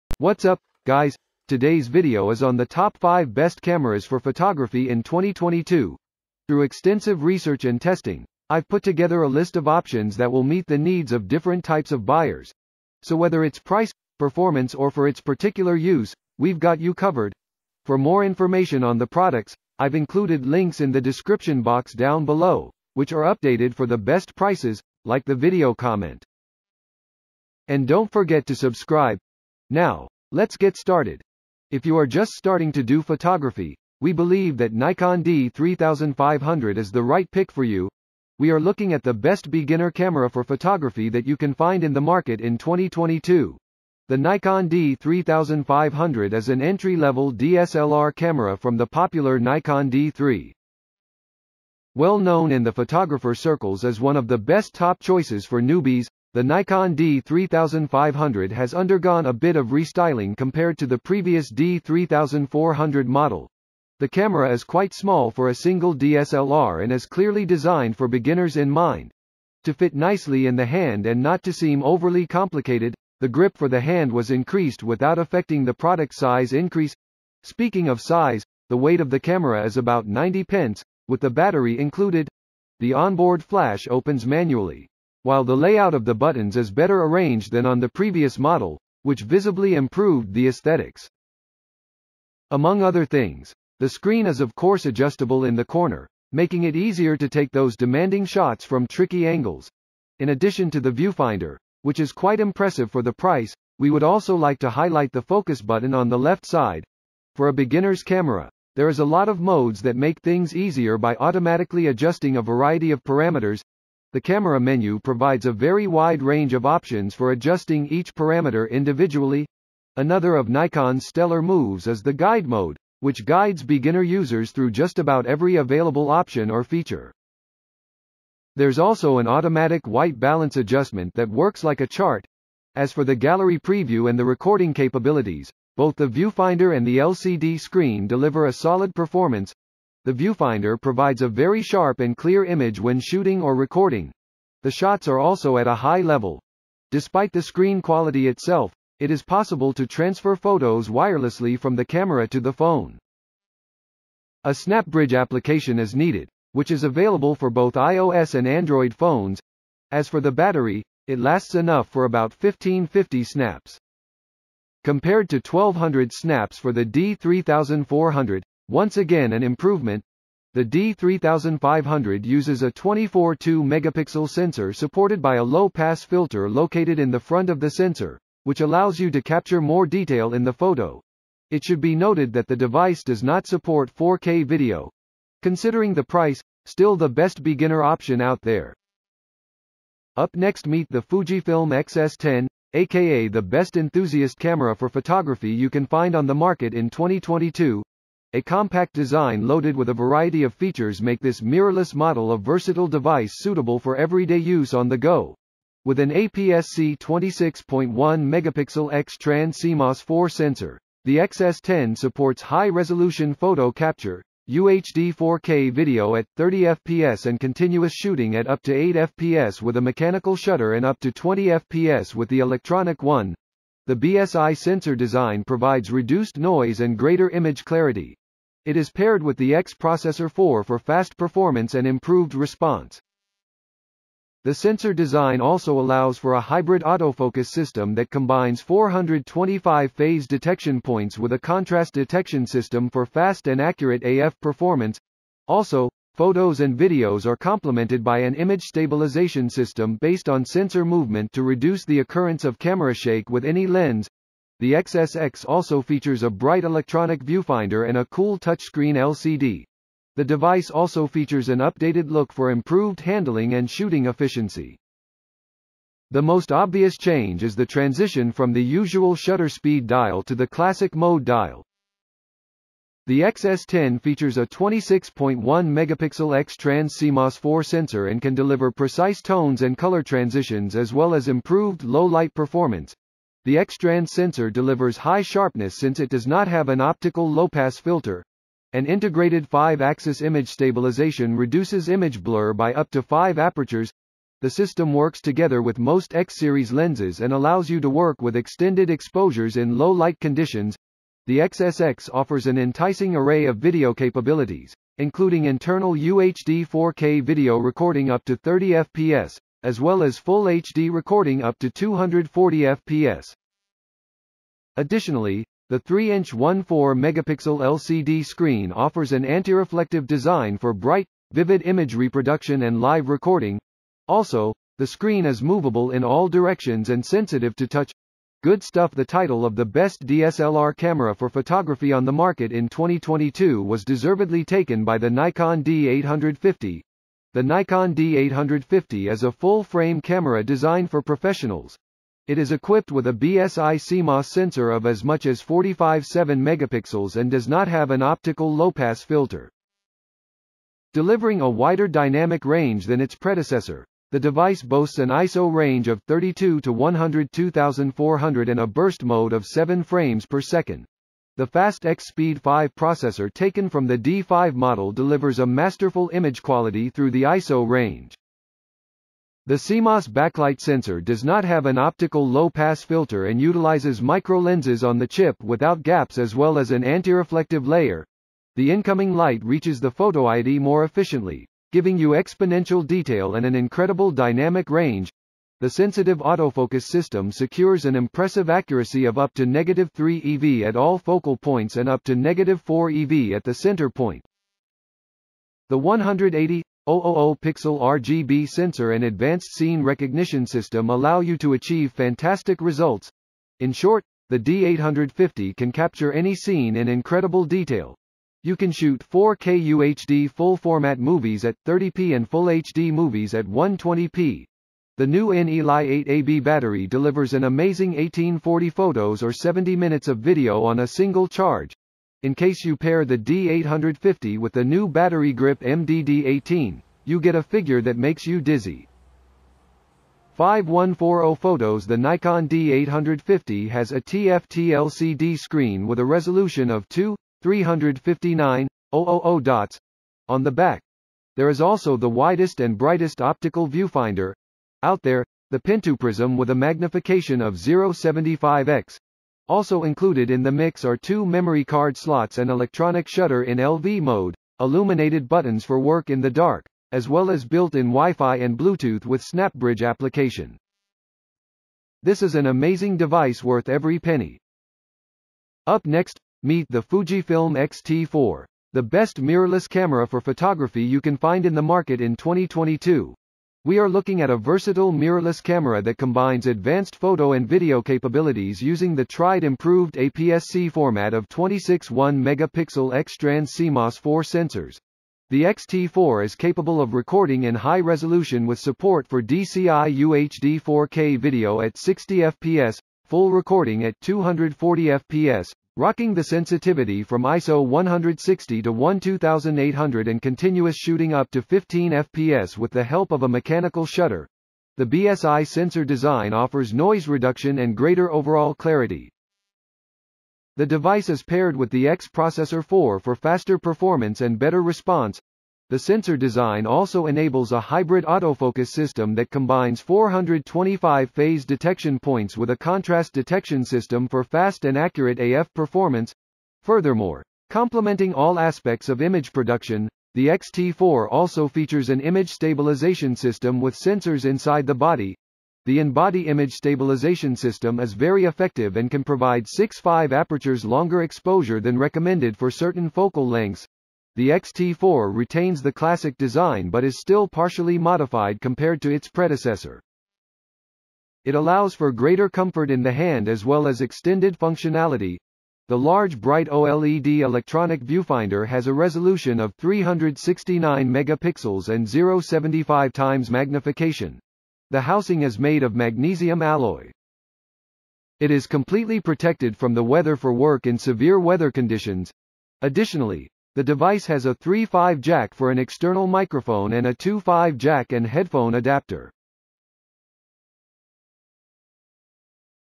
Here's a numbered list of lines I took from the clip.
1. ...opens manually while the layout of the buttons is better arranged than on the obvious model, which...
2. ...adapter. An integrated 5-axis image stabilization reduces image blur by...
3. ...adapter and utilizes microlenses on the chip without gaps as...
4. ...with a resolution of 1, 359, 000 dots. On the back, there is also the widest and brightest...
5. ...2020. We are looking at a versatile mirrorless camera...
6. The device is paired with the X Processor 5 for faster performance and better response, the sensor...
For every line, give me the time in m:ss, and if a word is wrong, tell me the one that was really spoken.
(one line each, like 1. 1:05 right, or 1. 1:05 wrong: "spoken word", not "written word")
1. 1:23 wrong: "previous", not "obvious"
2. 4:47 wrong: "filter", not "adapter"
3. 6:12 wrong: "filter", not "adapter"
4. 7:15 wrong: "2", not "1"
5. 7:52 wrong: "2022", not "2020"
6. 8:30 wrong: "4", not "5".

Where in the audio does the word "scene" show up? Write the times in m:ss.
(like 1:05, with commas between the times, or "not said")
6:39, 6:46.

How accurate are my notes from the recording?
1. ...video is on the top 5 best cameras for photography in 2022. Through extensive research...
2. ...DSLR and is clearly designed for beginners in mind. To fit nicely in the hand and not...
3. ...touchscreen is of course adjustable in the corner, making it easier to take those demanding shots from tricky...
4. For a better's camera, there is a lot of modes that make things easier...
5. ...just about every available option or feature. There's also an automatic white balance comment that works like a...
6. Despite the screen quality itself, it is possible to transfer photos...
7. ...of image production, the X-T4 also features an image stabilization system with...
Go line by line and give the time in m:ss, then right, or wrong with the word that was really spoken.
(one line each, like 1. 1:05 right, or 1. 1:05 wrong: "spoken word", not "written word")
1. 0:01 right
2. 1:05 right
3. 1:33 wrong: "screen", not "touchscreen"
4. 1:47 wrong: "beginner", not "better"
5. 2:04 wrong: "adjustment", not "comment"
6. 2:26 right
7. 8:48 right.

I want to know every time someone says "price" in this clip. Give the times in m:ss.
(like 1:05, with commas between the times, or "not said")
0:13, 0:24, 1:43, 3:06.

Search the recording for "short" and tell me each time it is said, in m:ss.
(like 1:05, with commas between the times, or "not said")
6:43.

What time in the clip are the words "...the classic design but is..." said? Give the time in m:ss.
9:05.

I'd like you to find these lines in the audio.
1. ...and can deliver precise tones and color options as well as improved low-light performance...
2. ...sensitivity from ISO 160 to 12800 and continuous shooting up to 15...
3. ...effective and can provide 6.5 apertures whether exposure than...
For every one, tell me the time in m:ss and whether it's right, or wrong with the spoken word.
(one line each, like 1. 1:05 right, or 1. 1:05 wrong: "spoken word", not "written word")
1. 4:38 wrong: "transitions", not "options"
2. 8:16 right
3. 8:58 wrong: "longer", not "whether".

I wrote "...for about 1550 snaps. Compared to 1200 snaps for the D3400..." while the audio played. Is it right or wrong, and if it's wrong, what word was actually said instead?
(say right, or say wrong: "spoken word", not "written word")
right.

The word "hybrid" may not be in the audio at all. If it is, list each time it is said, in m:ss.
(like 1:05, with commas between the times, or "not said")
3:56, 8:37.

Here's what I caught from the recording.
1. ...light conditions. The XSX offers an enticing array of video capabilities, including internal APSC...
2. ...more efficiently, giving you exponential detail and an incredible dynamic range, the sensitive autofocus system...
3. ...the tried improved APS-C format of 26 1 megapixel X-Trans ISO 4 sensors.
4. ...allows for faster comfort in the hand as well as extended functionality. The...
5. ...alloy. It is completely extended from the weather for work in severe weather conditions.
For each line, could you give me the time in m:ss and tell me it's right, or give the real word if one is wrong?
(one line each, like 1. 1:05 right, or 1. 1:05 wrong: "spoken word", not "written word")
1. 4:59 wrong: "UHD", not "APSC"
2. 6:20 right
3. 7:58 wrong: "CMOS", not "ISO"
4. 9:11 wrong: "greater", not "faster"
5. 9:26 wrong: "protected", not "extended".